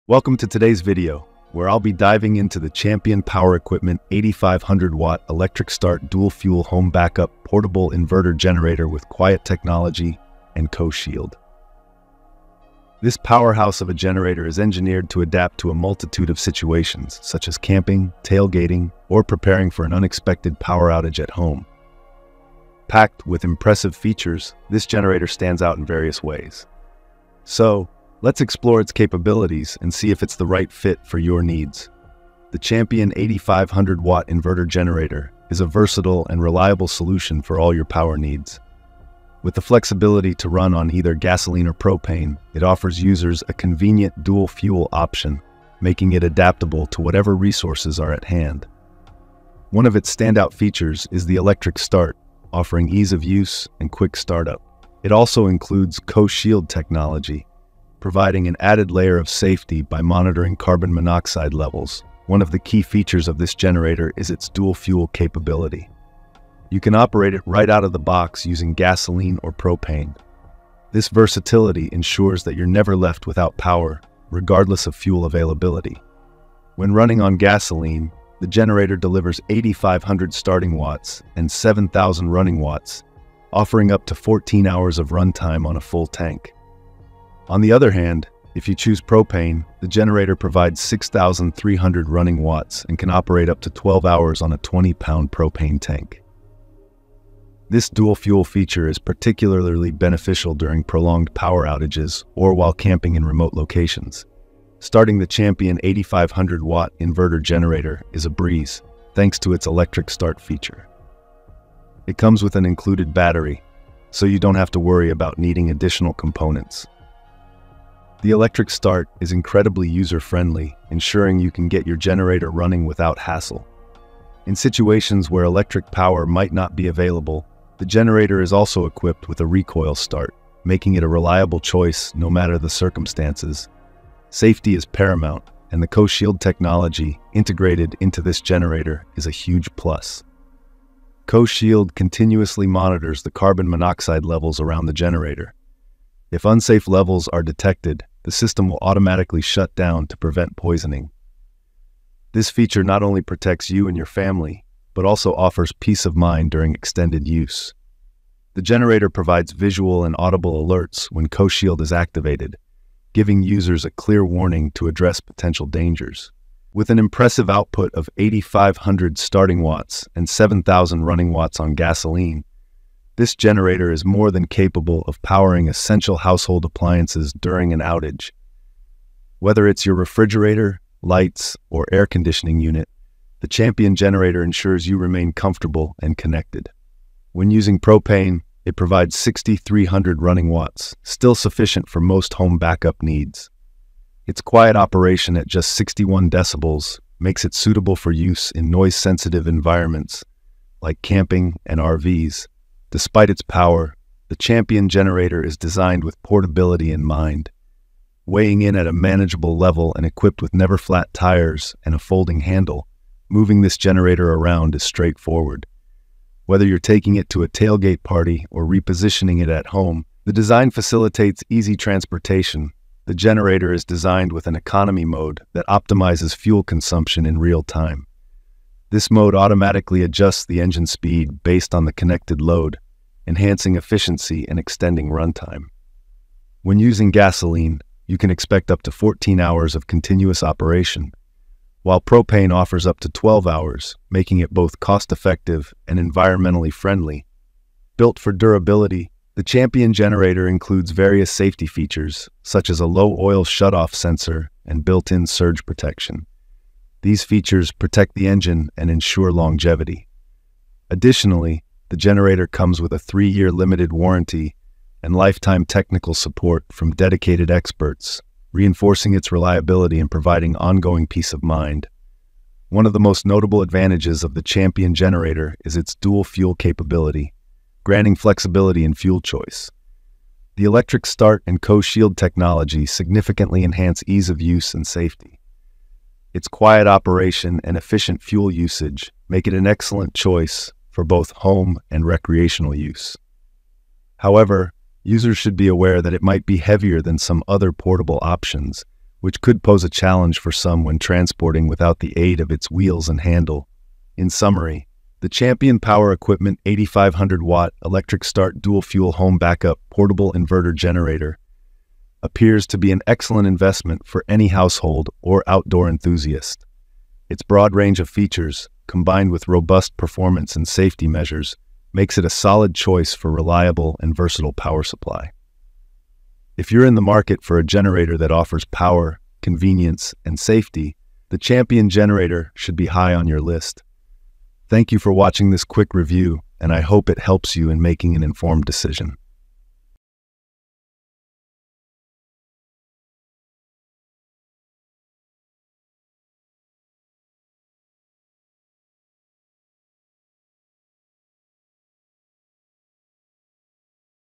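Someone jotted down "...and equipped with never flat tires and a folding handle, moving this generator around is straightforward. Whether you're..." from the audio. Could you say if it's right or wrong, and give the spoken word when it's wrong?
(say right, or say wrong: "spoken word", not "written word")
right.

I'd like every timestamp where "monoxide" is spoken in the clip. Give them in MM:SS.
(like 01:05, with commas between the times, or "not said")
01:00, 02:23.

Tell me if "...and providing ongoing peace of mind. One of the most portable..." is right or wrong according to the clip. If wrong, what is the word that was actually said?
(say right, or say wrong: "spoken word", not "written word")
wrong: "notable", not "portable".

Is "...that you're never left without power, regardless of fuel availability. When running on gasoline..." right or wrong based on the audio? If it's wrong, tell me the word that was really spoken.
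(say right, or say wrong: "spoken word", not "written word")
right.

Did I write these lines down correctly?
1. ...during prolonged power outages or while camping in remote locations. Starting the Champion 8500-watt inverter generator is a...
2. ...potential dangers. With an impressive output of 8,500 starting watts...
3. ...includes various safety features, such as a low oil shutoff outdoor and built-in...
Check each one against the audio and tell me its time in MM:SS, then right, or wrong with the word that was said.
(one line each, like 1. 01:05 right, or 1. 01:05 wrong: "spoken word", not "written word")
1. 01:40 right
2. 02:45 right
3. 04:10 wrong: "sensor", not "outdoor".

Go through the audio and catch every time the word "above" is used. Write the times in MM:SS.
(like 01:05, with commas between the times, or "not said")
not said.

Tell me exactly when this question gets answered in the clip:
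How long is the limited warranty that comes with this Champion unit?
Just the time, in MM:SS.
04:22.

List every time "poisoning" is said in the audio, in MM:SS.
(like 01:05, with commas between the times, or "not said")
02:30.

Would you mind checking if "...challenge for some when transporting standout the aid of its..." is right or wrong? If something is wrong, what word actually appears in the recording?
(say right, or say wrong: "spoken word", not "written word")
wrong: "without", not "standout".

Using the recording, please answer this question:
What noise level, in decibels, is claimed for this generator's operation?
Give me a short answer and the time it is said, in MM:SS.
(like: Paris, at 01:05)
61 decibels, at 03:15.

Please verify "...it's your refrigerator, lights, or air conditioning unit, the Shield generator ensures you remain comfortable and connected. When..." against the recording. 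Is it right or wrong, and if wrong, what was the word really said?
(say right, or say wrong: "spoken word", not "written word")
wrong: "Champion", not "Shield".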